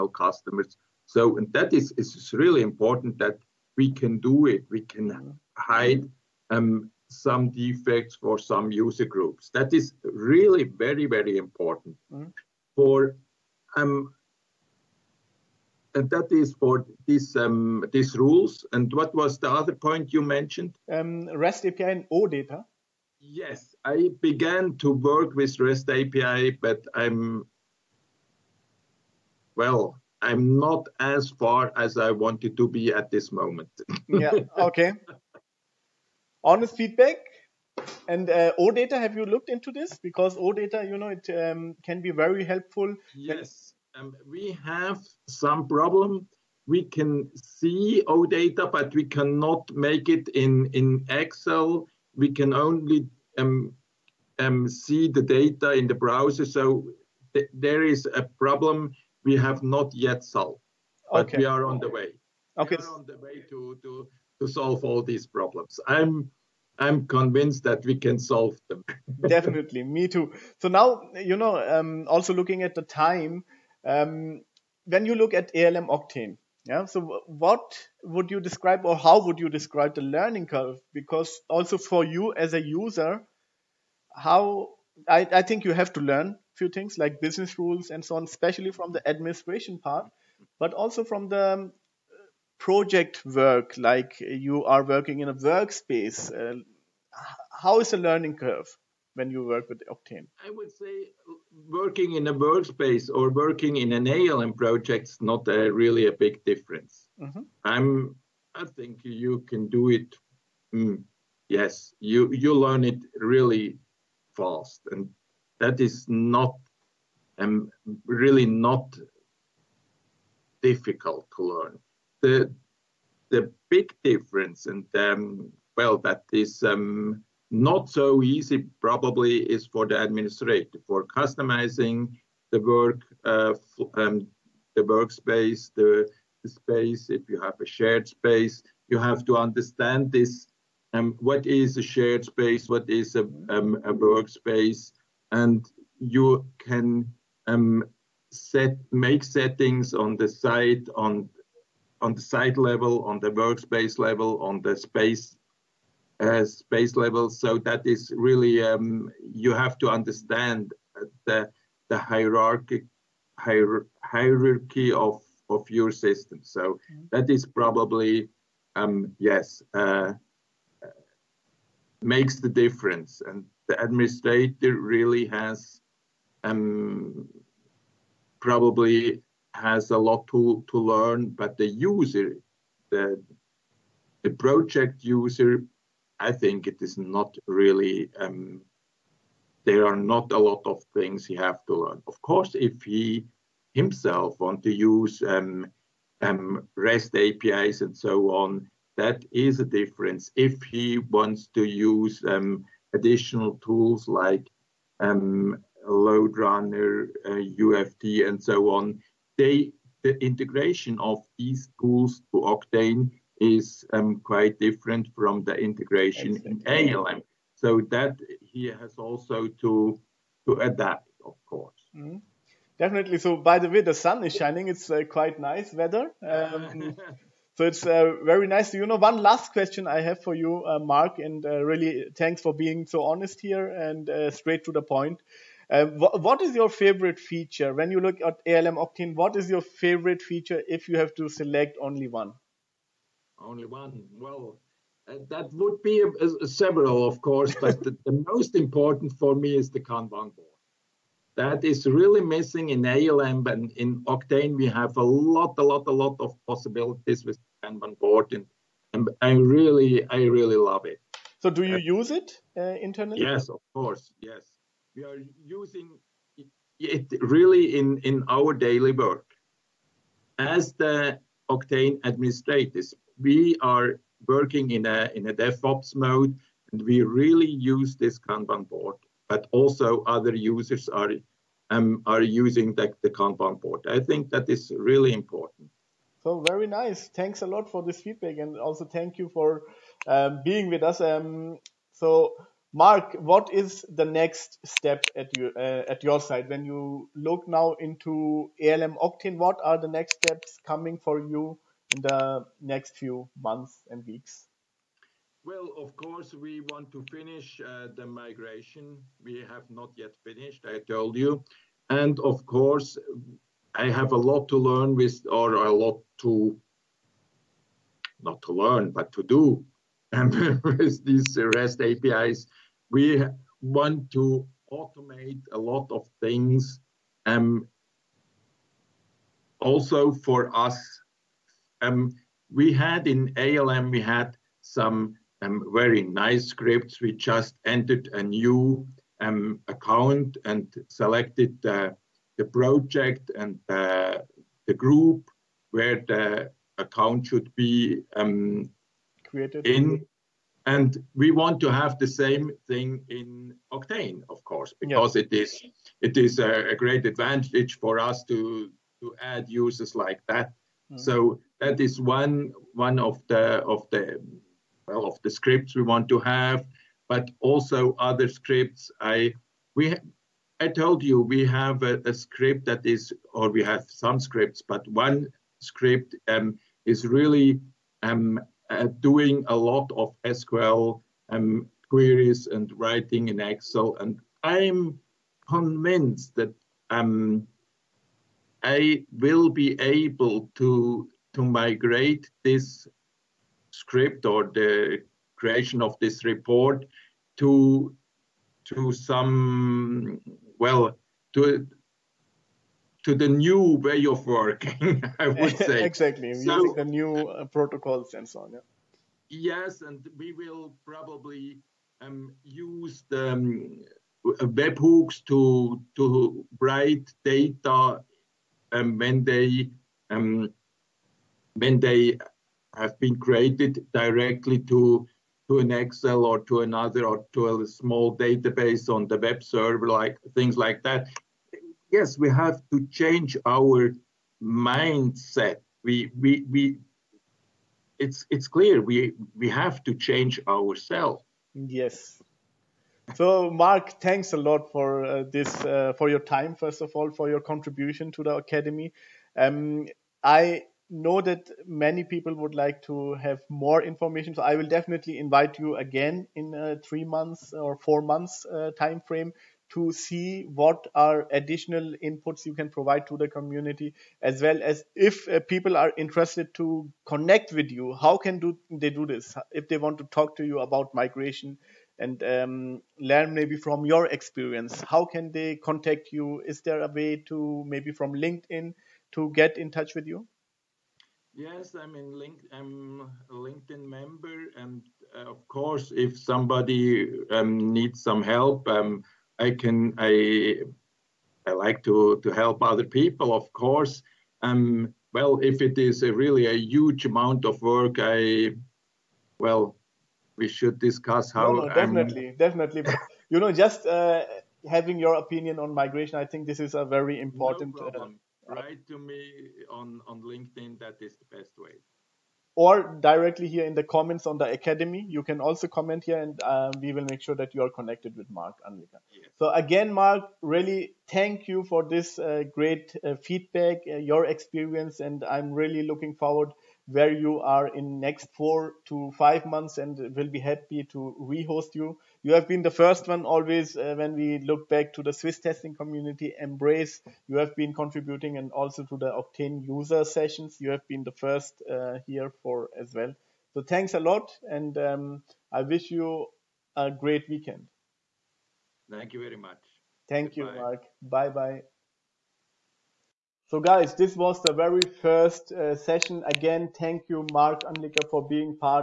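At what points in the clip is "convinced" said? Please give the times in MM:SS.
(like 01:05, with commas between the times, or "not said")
01:07, 06:25.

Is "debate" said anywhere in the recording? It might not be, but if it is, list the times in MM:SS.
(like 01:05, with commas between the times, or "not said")
not said.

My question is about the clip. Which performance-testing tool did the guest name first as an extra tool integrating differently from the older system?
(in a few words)
Load Runner.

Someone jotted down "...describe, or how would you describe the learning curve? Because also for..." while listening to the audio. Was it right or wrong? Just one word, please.
right.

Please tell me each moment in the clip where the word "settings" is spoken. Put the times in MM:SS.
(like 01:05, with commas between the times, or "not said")
02:29.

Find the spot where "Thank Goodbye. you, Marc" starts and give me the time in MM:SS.
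09:10.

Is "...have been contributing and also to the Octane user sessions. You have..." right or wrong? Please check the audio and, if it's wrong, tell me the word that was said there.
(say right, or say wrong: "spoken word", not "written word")
right.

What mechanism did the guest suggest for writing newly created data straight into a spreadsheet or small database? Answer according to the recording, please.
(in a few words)
webhooks.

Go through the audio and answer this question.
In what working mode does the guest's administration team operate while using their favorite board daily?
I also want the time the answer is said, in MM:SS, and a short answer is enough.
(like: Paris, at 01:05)
DevOps, at 04:35.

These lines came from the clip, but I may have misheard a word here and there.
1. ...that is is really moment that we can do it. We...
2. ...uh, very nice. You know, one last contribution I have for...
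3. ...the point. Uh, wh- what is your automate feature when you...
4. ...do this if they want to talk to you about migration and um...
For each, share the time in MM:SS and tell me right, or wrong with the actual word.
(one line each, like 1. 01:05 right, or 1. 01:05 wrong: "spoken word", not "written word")
1. 00:01 wrong: "important", not "moment"
2. 03:47 wrong: "question", not "contribution"
3. 03:54 wrong: "favorite", not "automate"
4. 07:48 right.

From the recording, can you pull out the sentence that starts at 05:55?
it is it is a, a, great advantage for us to to add users like that.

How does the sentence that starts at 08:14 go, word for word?
Um, well, if it is a really a huge amount of work, I well, we should discuss how.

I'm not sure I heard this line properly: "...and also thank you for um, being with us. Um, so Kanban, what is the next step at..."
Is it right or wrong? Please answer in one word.
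wrong.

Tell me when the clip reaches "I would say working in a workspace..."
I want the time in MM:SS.
01:40.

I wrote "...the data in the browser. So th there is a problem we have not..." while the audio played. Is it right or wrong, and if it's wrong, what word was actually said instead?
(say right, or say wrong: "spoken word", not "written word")
right.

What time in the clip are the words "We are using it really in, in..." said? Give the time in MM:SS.
04:24.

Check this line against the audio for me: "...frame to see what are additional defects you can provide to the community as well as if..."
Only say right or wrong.
wrong.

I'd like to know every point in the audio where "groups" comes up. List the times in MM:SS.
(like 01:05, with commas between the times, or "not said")
00:09, 05:44.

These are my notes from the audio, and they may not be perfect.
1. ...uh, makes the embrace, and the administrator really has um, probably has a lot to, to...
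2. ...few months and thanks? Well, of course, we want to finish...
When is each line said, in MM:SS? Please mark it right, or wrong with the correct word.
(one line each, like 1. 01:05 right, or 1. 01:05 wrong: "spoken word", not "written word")
1. 02:49 wrong: "difference", not "embrace"
2. 05:02 wrong: "weeks", not "thanks".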